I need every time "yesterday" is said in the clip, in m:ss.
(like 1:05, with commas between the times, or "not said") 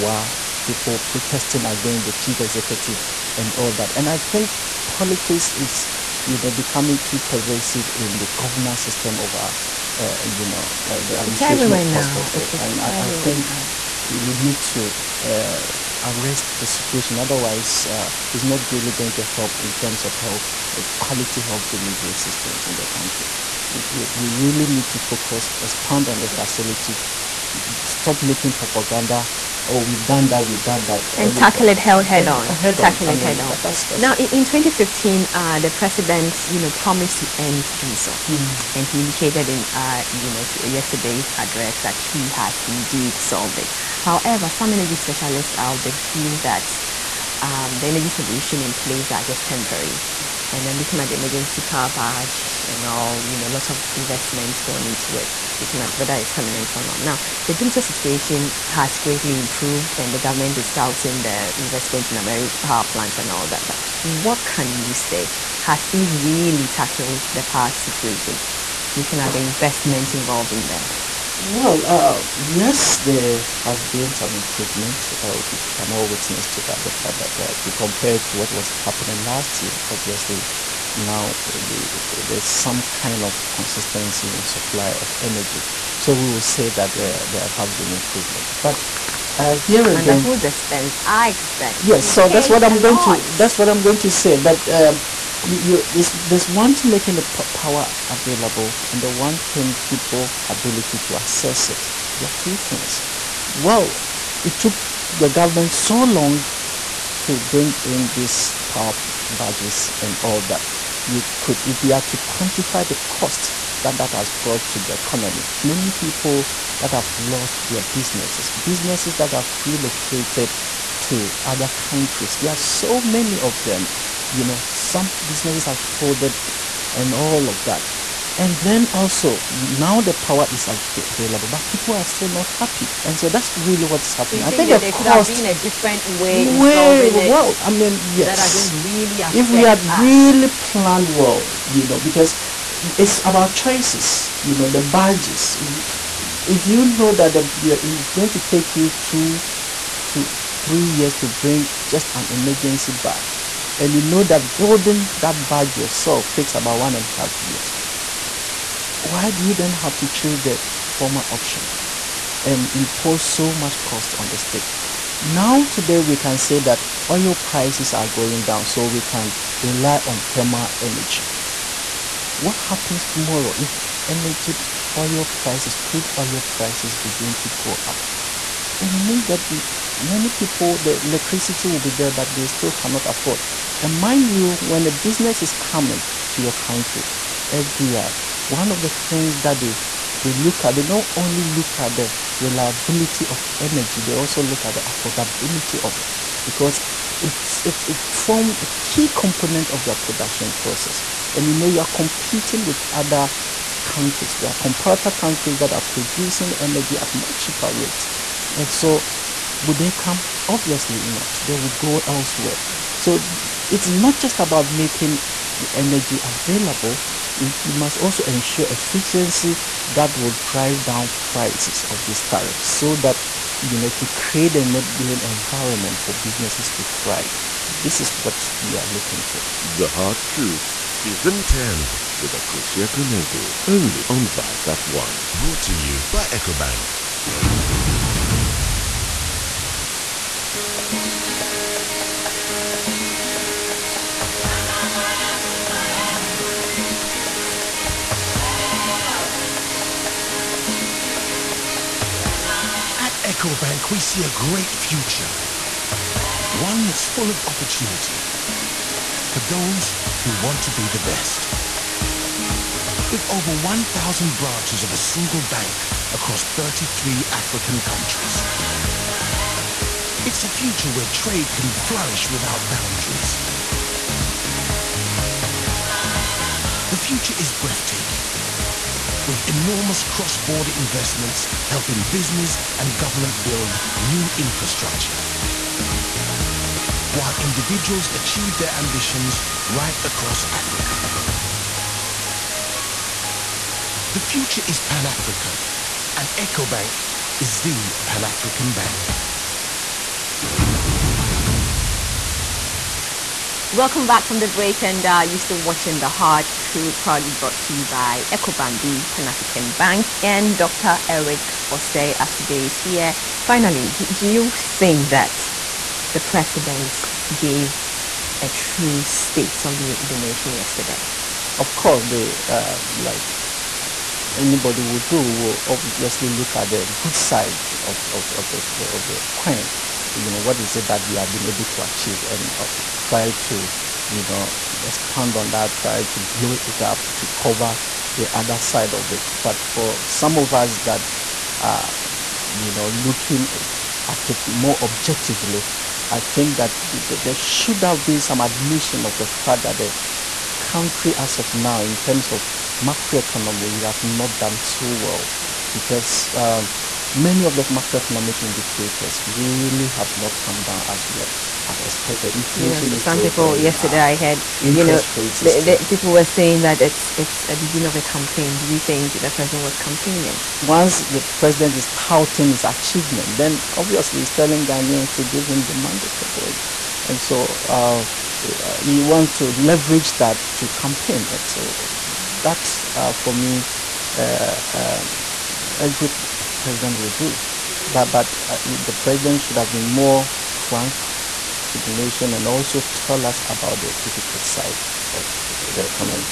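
0:40, 5:20, 6:03.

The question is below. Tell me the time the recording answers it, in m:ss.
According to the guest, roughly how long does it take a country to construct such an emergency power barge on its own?
2:36.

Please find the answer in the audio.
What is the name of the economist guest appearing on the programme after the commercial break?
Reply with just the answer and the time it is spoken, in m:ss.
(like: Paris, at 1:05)
Dr. Eric Osei Assibey, at 5:10.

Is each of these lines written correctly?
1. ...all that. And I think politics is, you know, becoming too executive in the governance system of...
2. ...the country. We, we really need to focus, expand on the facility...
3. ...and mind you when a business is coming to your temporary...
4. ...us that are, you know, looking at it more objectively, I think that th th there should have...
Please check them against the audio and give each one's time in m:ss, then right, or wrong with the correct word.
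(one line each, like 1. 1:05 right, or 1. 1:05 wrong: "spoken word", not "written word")
1. 0:03 wrong: "pervasive", not "executive"
2. 0:22 right
3. 3:03 wrong: "country", not "temporary"
4. 5:40 right.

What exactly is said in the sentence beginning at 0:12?
It's, it's and I, I think now.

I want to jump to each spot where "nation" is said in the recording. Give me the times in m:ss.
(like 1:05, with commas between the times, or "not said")
5:20, 6:31.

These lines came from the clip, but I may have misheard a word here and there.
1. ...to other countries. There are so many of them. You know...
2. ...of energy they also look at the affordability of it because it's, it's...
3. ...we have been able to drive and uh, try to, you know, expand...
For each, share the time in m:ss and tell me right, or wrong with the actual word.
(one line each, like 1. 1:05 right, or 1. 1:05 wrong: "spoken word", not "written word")
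1. 2:01 right
2. 3:13 right
3. 5:31 wrong: "achieve", not "drive".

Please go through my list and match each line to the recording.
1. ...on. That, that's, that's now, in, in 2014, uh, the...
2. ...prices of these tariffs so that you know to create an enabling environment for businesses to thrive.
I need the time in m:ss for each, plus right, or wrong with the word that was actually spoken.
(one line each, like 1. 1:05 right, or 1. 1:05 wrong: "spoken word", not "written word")
1. 0:33 wrong: "2015", not "2014"
2. 3:41 right.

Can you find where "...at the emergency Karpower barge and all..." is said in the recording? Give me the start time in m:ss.
0:50.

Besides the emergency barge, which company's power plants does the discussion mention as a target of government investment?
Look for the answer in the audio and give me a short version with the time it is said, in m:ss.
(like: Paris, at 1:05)
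AMERI, at 1:02.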